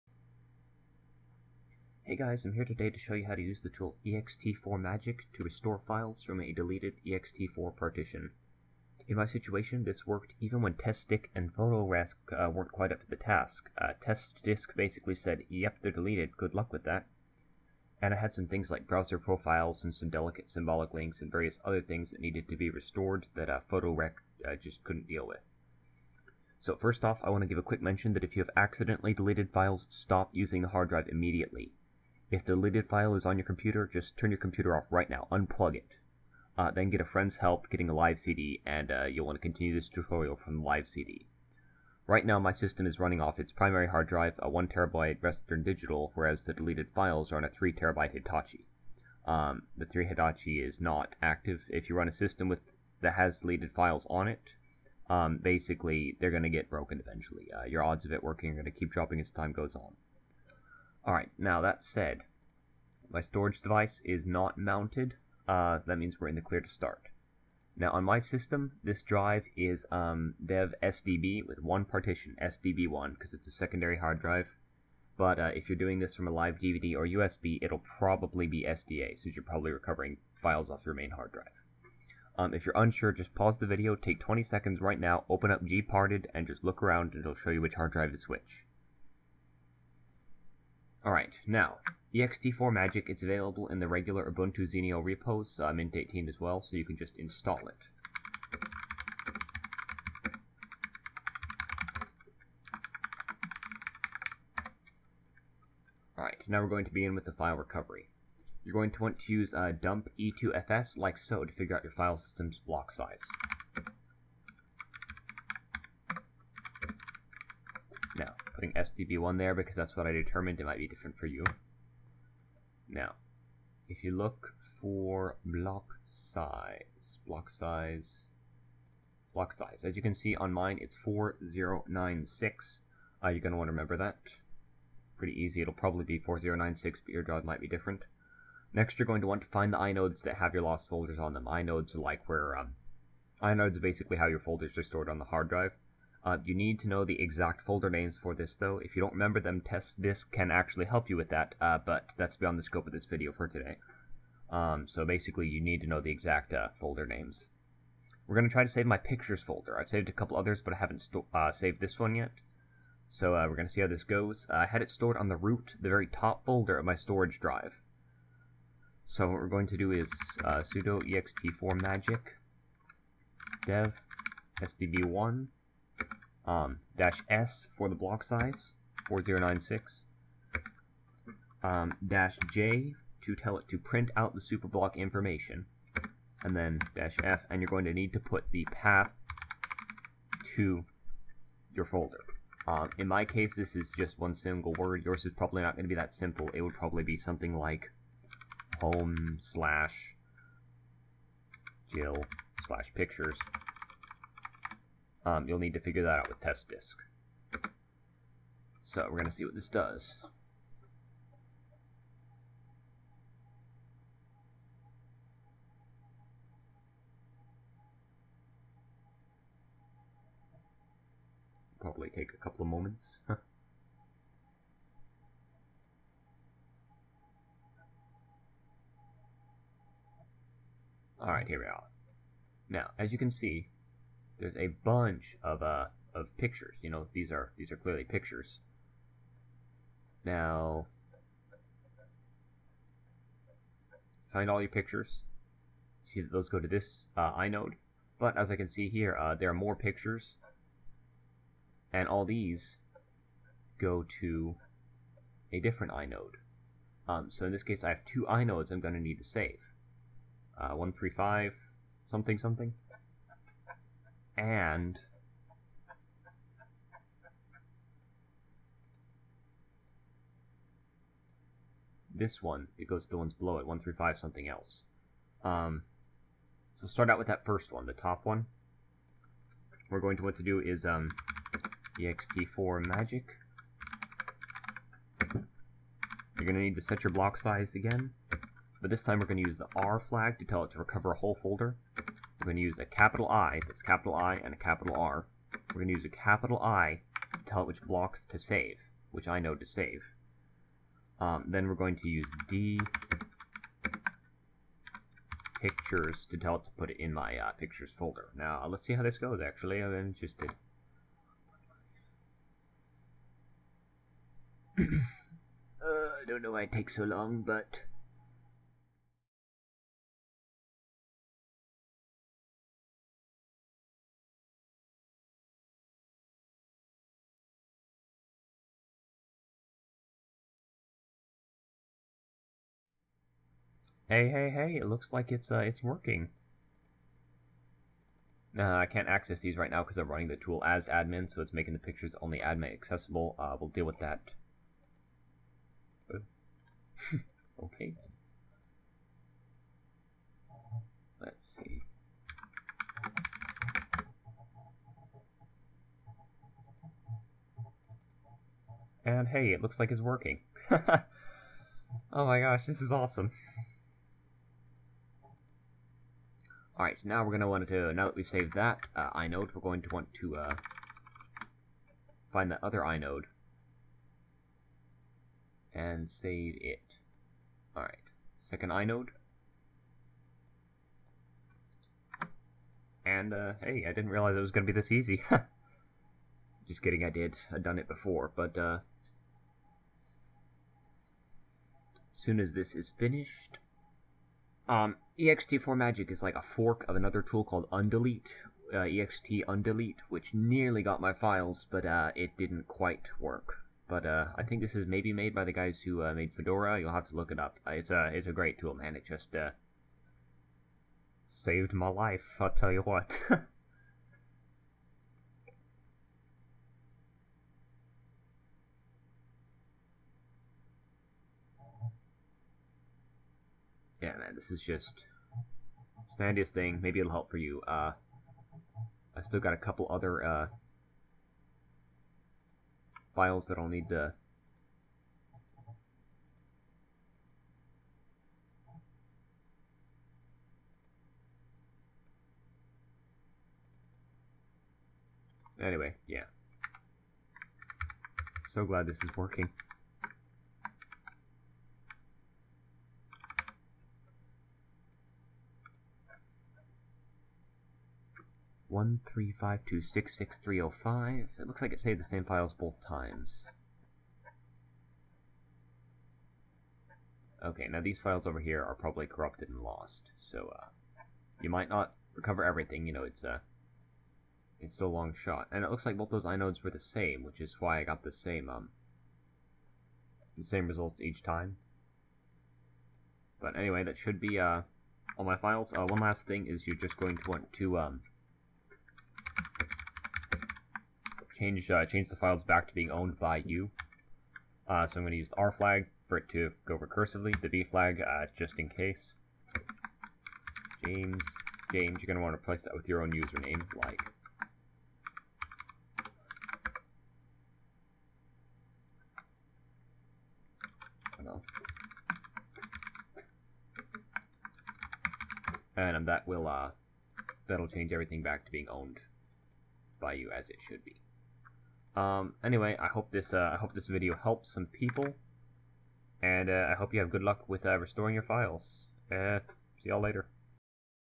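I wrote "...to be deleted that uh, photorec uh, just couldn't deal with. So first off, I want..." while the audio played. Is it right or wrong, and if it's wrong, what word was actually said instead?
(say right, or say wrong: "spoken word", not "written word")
wrong: "restored", not "deleted".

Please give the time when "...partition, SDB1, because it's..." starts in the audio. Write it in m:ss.
1:11.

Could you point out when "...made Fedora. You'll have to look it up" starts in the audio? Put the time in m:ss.
6:46.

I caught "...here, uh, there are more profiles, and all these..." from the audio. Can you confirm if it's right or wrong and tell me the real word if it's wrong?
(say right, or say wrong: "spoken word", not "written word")
wrong: "pictures", not "profiles".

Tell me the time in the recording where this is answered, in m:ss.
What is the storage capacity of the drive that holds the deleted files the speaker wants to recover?
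0:47.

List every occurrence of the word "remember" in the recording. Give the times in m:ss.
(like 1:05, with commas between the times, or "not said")
2:13, 2:29.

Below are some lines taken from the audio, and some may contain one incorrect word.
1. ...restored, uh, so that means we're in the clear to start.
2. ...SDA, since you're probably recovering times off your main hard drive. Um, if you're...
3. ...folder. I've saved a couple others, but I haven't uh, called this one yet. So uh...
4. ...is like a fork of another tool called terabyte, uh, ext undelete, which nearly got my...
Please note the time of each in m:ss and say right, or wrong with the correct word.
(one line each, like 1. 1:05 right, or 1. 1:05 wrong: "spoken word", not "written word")
1. 1:04 wrong: "mounted", not "restored"
2. 1:18 wrong: "files", not "times"
3. 2:39 wrong: "saved", not "called"
4. 6:36 wrong: "undelete", not "terabyte".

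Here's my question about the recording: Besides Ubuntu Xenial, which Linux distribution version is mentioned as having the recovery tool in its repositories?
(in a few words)
Mint 18.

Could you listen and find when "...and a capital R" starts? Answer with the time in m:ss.
4:54.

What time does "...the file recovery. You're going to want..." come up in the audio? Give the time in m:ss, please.
1:47.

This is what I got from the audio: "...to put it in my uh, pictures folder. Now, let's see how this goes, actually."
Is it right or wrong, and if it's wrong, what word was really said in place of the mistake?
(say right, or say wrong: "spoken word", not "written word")
right.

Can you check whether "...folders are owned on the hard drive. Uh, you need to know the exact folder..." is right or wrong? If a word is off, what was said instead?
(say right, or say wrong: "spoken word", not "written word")
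wrong: "stored", not "owned".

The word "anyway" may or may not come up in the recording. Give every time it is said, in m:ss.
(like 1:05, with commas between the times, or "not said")
7:25, 8:03, 8:42.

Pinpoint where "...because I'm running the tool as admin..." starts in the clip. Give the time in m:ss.
5:39.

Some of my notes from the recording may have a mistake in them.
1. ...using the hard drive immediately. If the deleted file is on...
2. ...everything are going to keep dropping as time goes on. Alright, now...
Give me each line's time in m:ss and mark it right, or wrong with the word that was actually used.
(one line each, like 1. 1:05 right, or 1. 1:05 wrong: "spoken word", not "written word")
1. 0:30 right
2. 0:58 wrong: "working", not "everything".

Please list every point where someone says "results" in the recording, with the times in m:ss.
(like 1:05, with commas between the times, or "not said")
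8:00.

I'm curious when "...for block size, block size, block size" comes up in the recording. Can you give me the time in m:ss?
2:04.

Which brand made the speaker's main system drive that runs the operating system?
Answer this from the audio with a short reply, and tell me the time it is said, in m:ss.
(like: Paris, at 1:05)
Western Digital, at 0:45.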